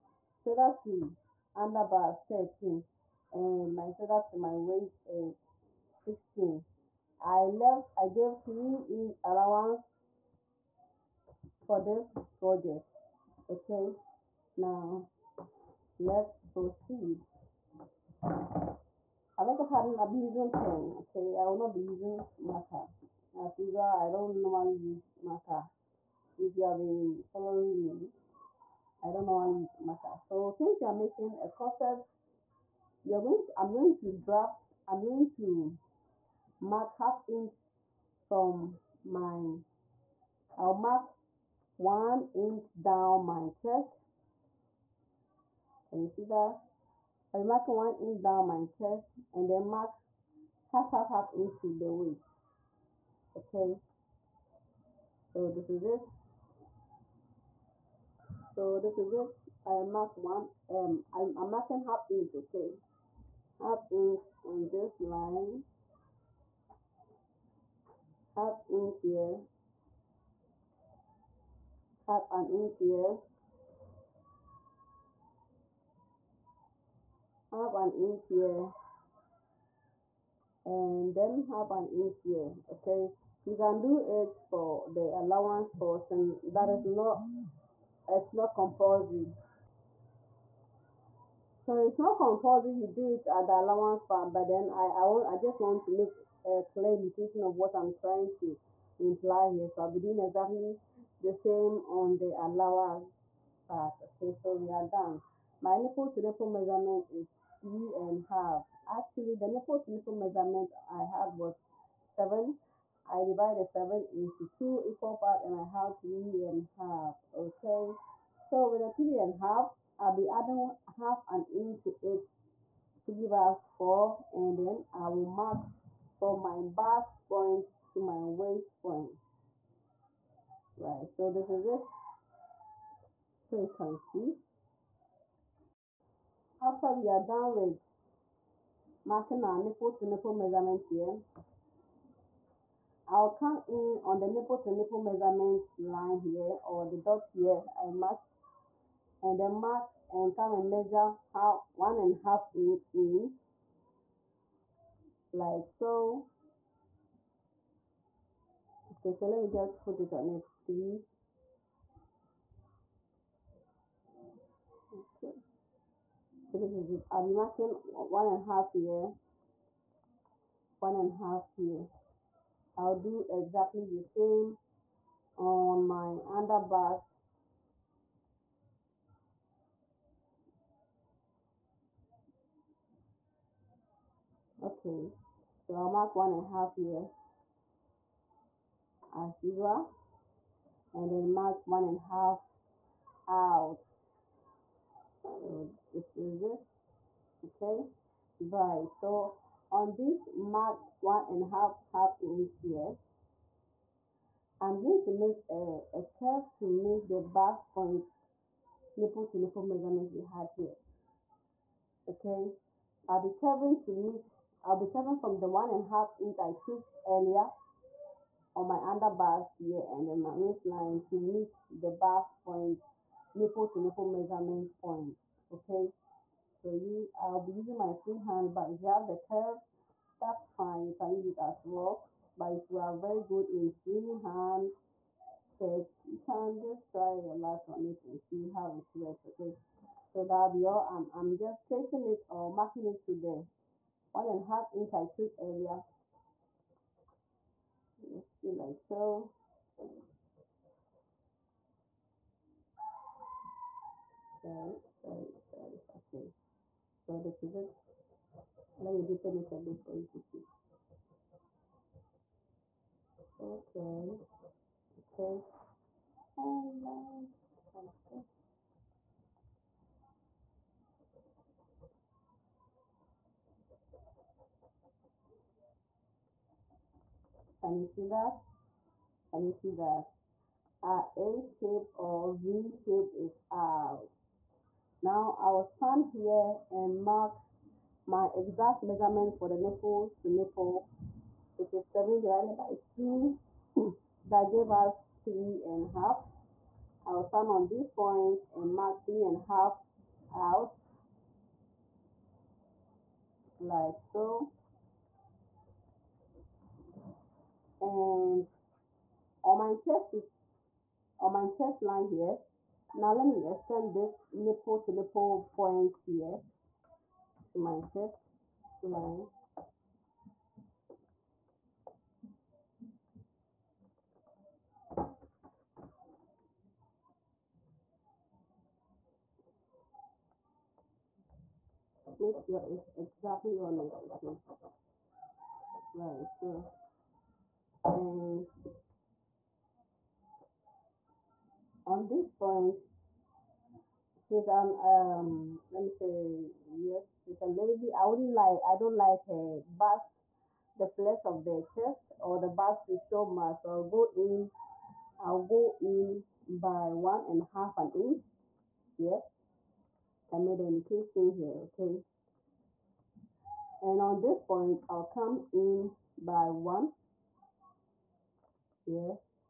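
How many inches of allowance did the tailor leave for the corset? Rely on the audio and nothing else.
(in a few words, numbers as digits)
3 inches.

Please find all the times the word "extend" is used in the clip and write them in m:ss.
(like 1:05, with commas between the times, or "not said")
5:13.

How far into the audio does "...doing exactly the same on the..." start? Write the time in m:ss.
1:39.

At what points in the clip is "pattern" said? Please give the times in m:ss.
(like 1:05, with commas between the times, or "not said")
0:19.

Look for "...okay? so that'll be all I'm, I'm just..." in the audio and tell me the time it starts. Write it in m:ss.
3:59.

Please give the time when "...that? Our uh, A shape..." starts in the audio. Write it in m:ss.
4:39.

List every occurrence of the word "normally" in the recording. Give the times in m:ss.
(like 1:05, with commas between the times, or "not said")
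0:24, 0:29.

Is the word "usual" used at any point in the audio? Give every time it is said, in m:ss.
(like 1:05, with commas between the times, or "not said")
0:23, 3:09.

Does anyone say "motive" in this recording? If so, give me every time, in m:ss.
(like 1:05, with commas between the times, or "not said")
not said.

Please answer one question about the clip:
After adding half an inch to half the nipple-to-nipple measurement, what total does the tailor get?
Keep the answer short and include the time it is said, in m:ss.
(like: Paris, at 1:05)
4, at 2:03.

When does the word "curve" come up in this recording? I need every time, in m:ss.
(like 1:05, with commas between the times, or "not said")
3:26, 3:49.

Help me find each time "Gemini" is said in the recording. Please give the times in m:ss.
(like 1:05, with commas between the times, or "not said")
not said.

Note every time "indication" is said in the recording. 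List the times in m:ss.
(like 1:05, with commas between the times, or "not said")
1:36, 6:00.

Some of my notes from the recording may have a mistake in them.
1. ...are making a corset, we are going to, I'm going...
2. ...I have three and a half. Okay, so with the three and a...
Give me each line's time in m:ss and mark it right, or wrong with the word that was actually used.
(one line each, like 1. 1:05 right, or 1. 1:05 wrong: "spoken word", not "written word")
1. 0:30 right
2. 1:55 right.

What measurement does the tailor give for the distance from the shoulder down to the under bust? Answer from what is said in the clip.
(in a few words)
13.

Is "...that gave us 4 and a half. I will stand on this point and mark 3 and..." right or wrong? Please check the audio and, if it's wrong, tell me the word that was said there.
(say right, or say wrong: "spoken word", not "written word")
wrong: "3", not "4".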